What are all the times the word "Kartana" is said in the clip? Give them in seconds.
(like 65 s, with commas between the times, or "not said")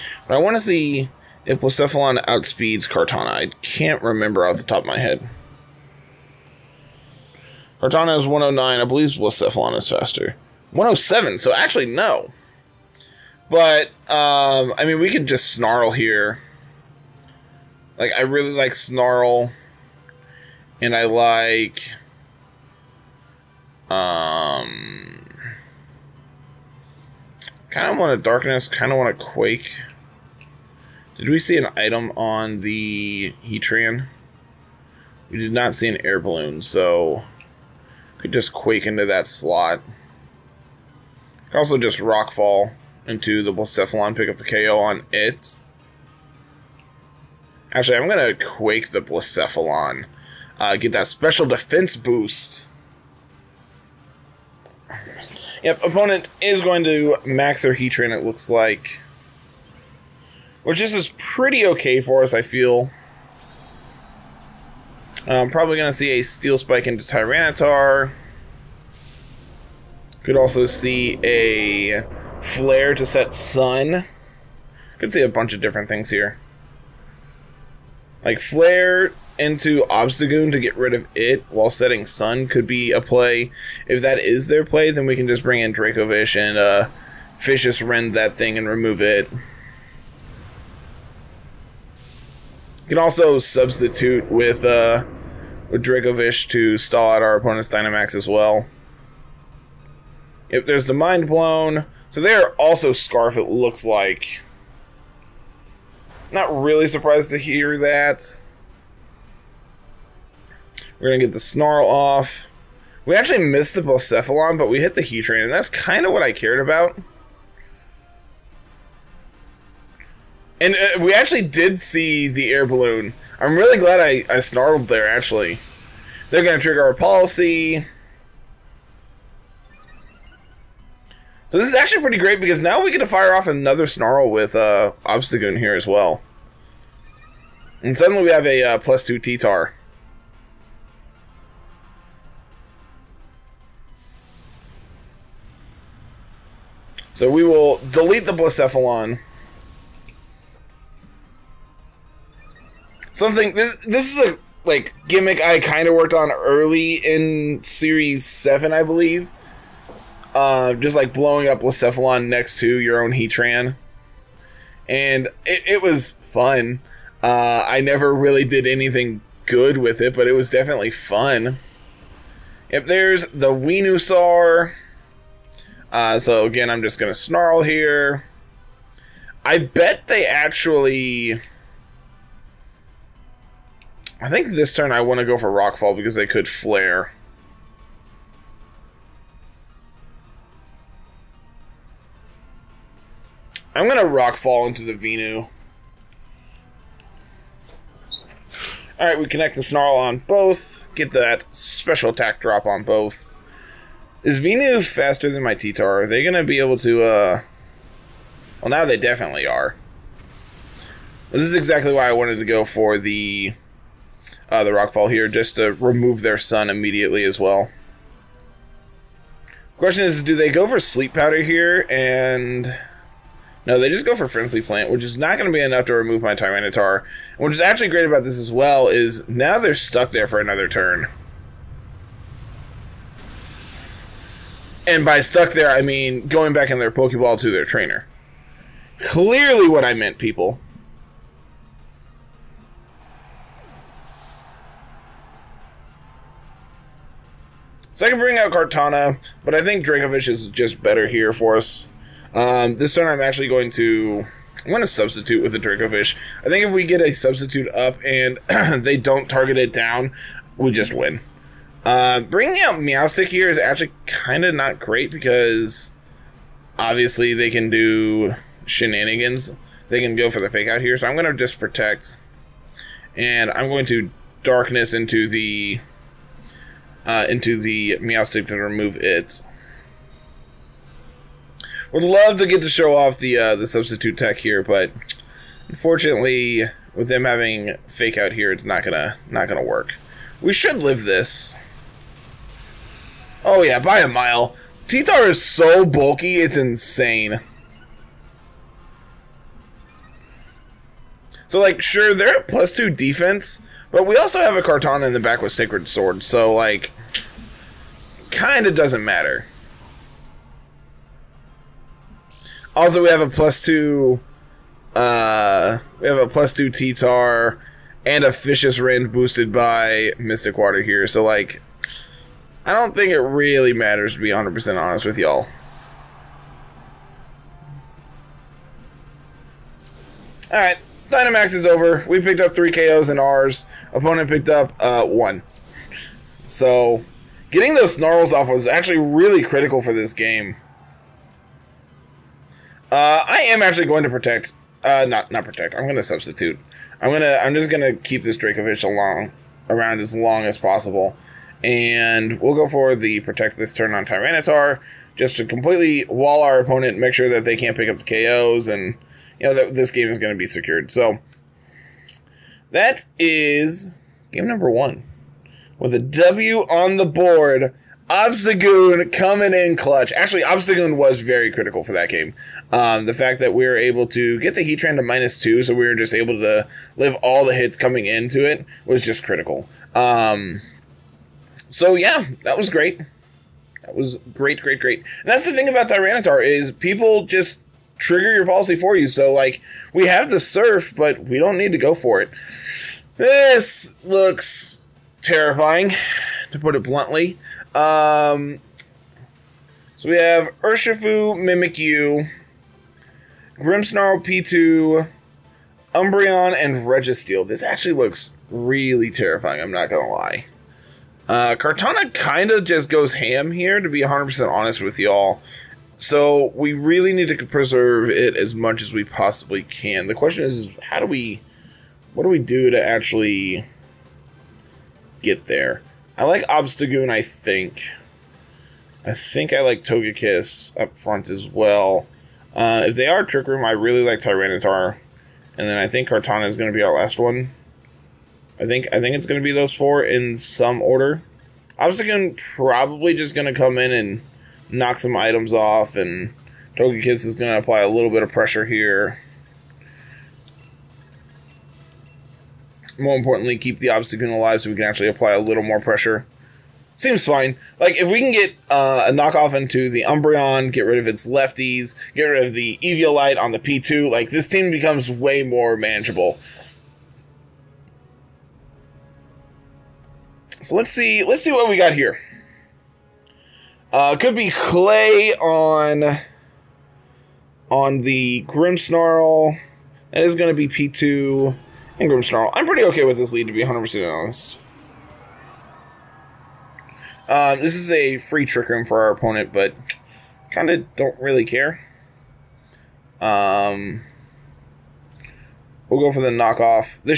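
2 s, 7 s, 248 s, 304 s, 411 s, 436 s.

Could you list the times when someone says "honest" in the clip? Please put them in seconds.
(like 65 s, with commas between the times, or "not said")
324 s, 414 s, 484 s.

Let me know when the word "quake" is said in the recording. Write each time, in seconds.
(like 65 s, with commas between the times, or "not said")
29 s, 38 s, 48 s.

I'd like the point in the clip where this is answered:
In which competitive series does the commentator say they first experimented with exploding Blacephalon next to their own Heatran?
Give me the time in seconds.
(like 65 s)
157 s.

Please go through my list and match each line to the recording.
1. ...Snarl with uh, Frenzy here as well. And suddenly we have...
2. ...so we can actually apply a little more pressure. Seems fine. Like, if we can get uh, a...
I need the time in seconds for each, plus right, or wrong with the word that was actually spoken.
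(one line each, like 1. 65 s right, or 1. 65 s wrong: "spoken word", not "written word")
1. 133 s wrong: "Obstagoon", not "Frenzy"
2. 454 s right.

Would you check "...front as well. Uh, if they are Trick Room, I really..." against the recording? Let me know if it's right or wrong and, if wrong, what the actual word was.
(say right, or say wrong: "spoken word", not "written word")
right.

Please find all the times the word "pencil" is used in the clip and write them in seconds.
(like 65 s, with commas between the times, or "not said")
not said.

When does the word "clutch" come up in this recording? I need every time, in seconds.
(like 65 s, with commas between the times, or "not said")
369 s.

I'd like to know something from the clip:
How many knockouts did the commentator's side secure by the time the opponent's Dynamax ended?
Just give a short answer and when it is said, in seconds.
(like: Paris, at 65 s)
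3, at 332 s.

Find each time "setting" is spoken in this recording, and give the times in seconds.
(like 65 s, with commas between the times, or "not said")
81 s.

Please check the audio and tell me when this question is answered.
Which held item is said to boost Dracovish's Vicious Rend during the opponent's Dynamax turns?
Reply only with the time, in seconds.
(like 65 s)
320 s.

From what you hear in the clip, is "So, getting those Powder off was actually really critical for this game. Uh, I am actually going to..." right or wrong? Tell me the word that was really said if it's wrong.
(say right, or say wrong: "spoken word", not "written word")
wrong: "Snarls", not "Powder".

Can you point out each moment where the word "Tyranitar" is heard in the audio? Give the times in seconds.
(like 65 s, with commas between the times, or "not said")
67 s, 226 s, 354 s, 385 s, 434 s.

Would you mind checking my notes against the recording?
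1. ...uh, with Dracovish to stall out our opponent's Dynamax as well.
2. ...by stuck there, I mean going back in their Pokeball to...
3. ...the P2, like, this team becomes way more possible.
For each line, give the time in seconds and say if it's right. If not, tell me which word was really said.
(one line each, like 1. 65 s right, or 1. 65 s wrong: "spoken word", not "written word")
1. 94 s right
2. 235 s right
3. 463 s wrong: "manageable", not "possible".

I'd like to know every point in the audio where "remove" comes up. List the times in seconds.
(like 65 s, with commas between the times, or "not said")
88 s, 215 s, 225 s, 278 s.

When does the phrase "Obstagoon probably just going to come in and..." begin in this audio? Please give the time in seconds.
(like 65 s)
441 s.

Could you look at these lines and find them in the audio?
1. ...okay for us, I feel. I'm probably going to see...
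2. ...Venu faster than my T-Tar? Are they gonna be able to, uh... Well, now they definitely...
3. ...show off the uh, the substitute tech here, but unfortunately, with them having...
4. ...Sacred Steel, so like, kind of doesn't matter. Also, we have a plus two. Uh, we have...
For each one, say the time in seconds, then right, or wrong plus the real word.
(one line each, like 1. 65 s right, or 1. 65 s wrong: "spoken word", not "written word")
1. 61 s right
2. 204 s right
3. 282 s right
4. 305 s wrong: "Sword", not "Steel".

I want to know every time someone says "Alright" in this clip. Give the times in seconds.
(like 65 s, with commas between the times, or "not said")
198 s, 330 s.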